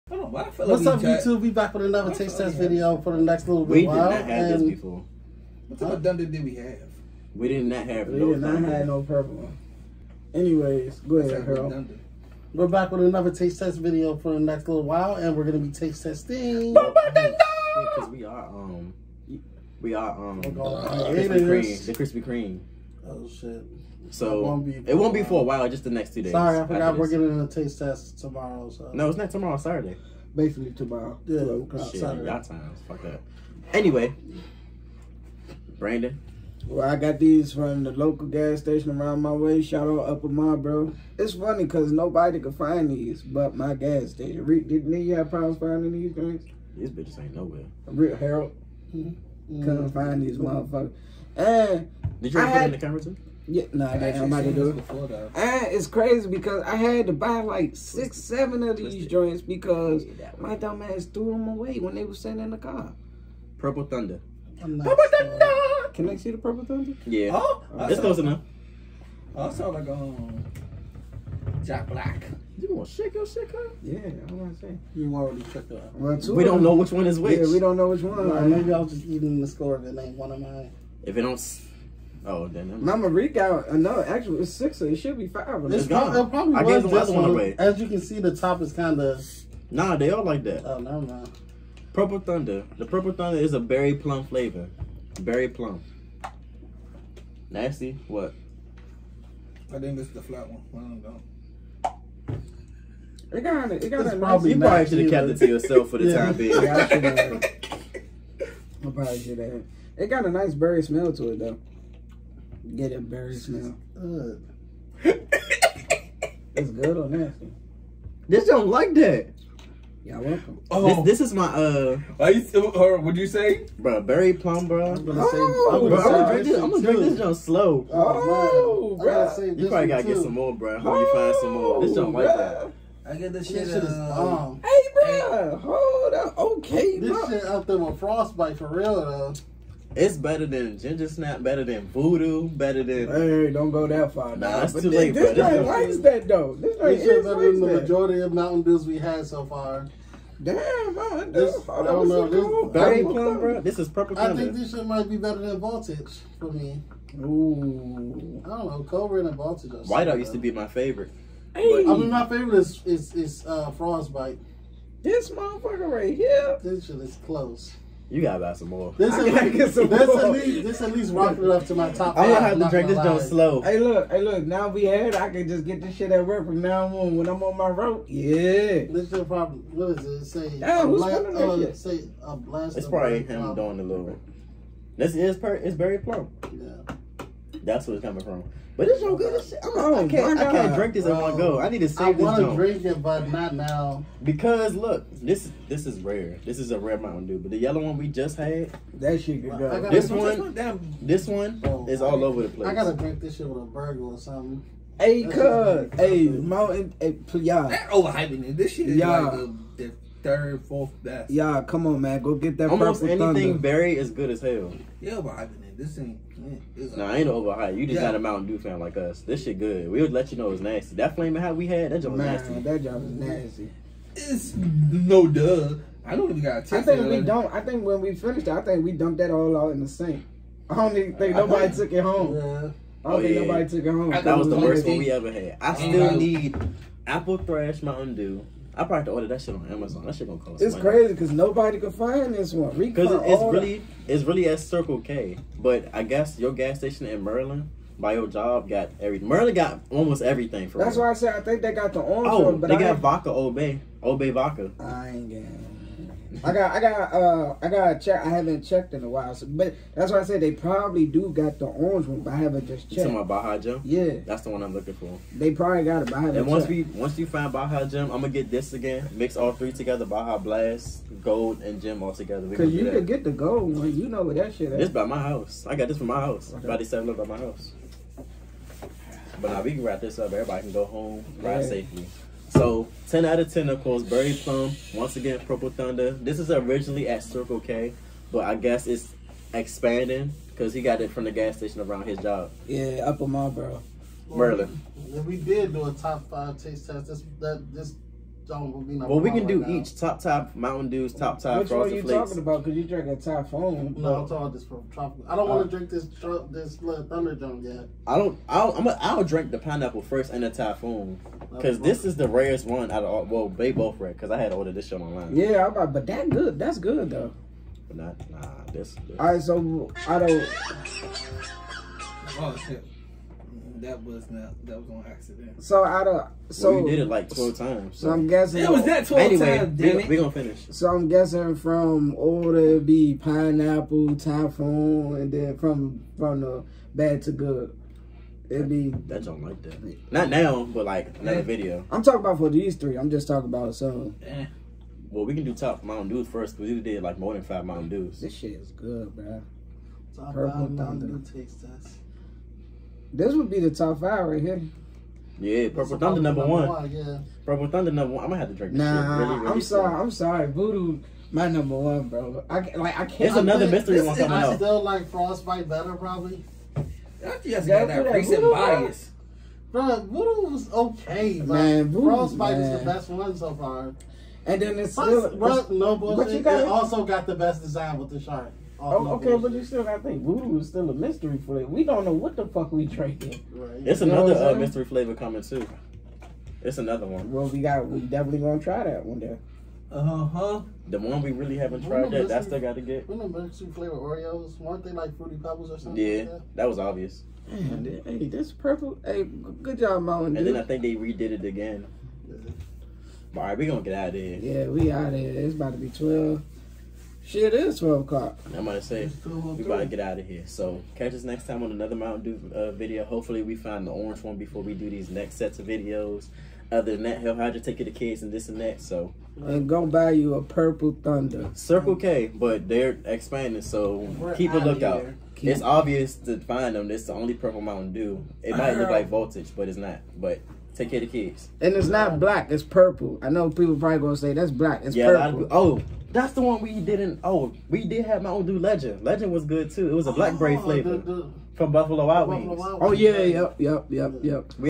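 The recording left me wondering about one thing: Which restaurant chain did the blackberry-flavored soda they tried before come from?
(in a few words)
Buffalo Wild Wings.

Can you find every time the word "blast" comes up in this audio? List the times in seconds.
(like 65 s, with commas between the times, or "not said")
182 s, 270 s.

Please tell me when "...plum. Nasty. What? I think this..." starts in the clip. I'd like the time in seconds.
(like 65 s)
95 s.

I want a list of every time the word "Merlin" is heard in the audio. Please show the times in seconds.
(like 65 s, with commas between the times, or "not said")
249 s, 294 s.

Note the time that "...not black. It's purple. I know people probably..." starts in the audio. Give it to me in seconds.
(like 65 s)
431 s.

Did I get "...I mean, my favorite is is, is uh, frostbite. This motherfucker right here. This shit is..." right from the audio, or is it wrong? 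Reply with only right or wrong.
right.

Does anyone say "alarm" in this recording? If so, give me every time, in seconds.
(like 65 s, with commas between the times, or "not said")
not said.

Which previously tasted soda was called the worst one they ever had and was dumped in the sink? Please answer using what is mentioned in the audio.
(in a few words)
Flaming Hot.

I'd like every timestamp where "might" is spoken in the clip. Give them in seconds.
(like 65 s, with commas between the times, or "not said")
154 s, 428 s.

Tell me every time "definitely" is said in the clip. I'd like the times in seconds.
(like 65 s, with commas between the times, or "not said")
387 s.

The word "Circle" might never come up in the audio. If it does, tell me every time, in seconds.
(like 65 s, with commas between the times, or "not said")
244 s, 287 s, 421 s.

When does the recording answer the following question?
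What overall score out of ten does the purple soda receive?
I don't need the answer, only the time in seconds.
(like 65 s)
283 s.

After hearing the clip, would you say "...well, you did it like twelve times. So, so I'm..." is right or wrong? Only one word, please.
right.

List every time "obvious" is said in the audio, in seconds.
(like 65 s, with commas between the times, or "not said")
396 s, 425 s.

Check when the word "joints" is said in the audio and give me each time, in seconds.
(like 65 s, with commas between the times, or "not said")
59 s, 172 s.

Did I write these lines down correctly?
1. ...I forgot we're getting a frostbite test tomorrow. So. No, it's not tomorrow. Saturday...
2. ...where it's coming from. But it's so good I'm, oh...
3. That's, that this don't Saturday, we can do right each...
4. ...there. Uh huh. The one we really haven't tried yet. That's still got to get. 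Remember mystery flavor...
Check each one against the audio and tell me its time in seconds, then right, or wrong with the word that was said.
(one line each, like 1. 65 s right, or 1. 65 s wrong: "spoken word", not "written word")
1. 26 s wrong: "taste", not "frostbite"
2. 187 s right
3. 297 s wrong: "Well", not "Saturday"
4. 389 s right.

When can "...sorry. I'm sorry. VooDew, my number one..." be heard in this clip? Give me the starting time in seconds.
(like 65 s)
359 s.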